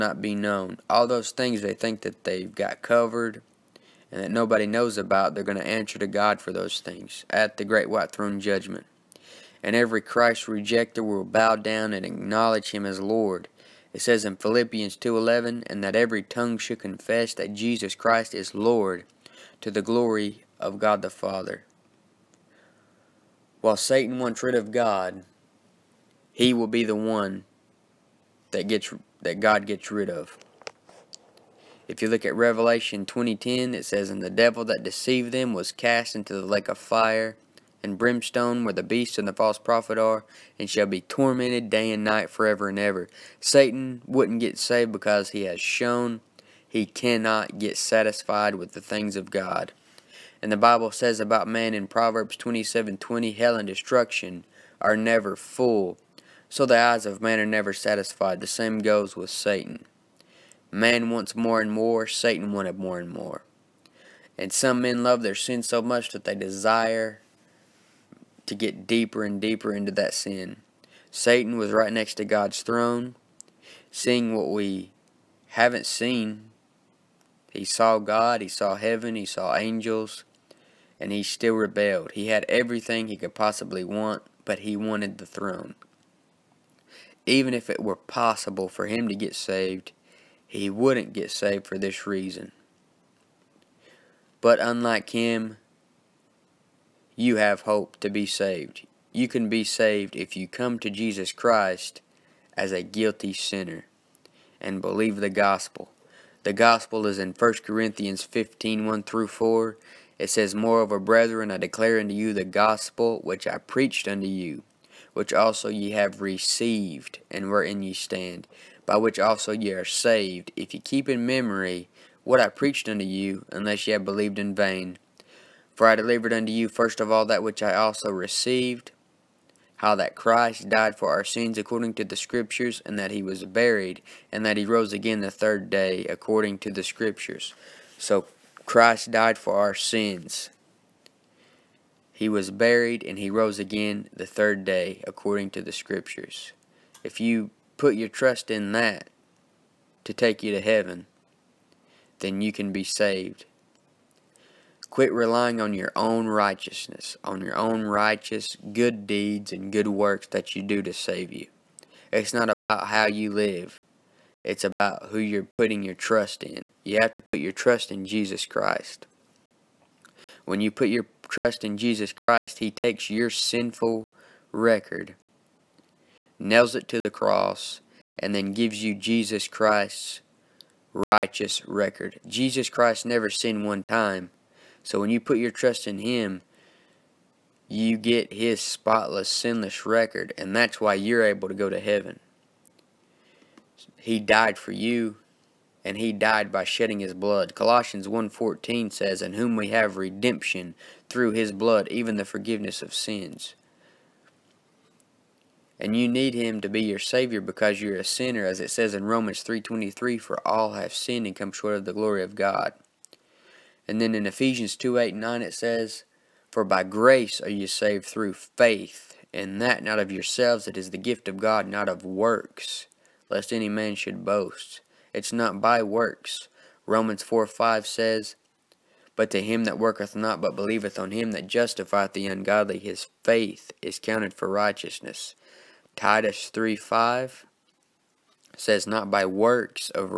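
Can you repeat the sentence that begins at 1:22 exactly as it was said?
He had everything he could possibly want, but he wanted the throne.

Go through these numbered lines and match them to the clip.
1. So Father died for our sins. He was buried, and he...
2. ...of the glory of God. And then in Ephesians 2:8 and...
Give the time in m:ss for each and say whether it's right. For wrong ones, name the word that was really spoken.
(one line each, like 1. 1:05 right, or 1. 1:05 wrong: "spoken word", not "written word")
1. 2:17 wrong: "Christ", not "Father"
2. 3:31 right.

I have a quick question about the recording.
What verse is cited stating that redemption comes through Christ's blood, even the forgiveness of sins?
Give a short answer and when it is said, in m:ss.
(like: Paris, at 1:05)
Colossians 1:14, at 3:17.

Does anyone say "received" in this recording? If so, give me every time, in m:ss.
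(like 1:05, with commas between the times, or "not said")
1:56, 2:08.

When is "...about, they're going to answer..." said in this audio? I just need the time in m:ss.
0:04.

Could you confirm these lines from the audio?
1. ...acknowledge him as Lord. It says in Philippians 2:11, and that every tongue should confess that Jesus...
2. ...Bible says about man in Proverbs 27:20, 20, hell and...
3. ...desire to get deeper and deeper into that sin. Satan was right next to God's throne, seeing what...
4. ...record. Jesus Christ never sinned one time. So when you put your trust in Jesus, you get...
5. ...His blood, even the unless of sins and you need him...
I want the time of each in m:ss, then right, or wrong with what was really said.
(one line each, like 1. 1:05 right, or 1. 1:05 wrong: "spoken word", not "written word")
1. 0:12 right
2. 0:50 right
3. 1:06 right
4. 3:01 wrong: "Him", not "Jesus"
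5. 3:21 wrong: "forgiveness", not "unless".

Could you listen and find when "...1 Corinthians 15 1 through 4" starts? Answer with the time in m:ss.
1:47.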